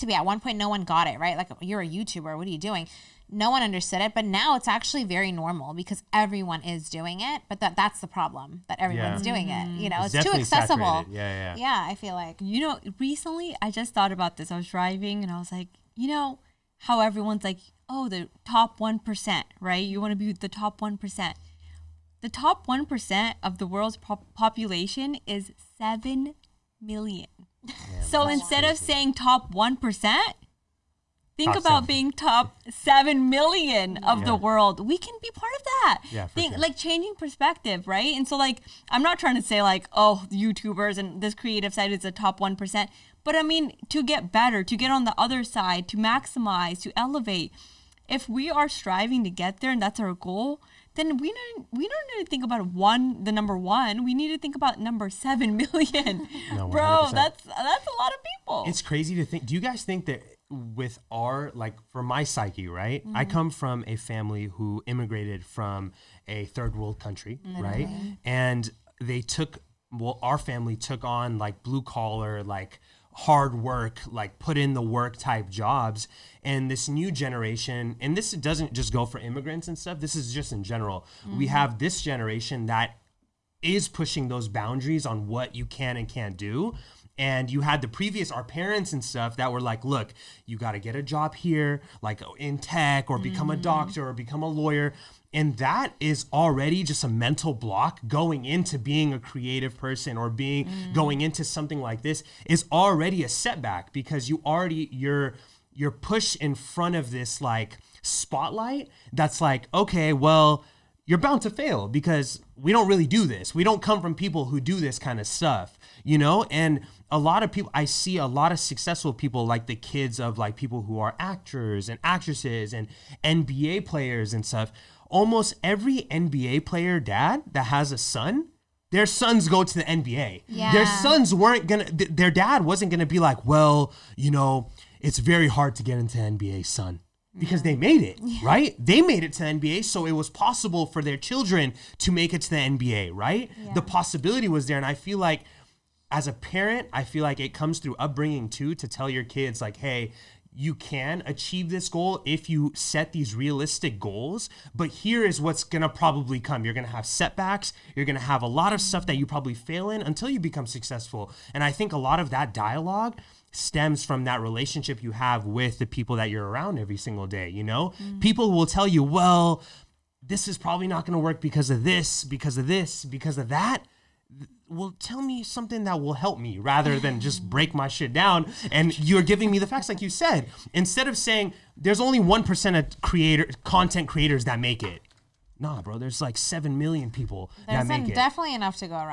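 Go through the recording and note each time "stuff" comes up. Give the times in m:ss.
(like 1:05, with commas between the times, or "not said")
1:19, 1:29, 1:55, 2:04, 2:38.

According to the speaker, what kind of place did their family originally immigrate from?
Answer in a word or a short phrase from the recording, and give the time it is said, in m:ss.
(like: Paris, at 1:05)
a third world country, at 1:06.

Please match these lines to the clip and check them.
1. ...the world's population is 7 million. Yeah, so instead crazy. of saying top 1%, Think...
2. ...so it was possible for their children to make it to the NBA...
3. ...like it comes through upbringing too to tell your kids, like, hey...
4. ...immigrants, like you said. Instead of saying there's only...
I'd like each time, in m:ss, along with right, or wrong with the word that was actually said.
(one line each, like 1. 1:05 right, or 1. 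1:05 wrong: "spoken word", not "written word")
1. 0:23 right
2. 2:19 right
3. 2:27 right
4. 2:59 wrong: "facts", not "immigrants".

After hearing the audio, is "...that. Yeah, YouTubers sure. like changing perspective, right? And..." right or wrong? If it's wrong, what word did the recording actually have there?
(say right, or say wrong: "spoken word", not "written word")
wrong: "Think", not "YouTubers".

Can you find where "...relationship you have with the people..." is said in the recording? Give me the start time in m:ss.
2:44.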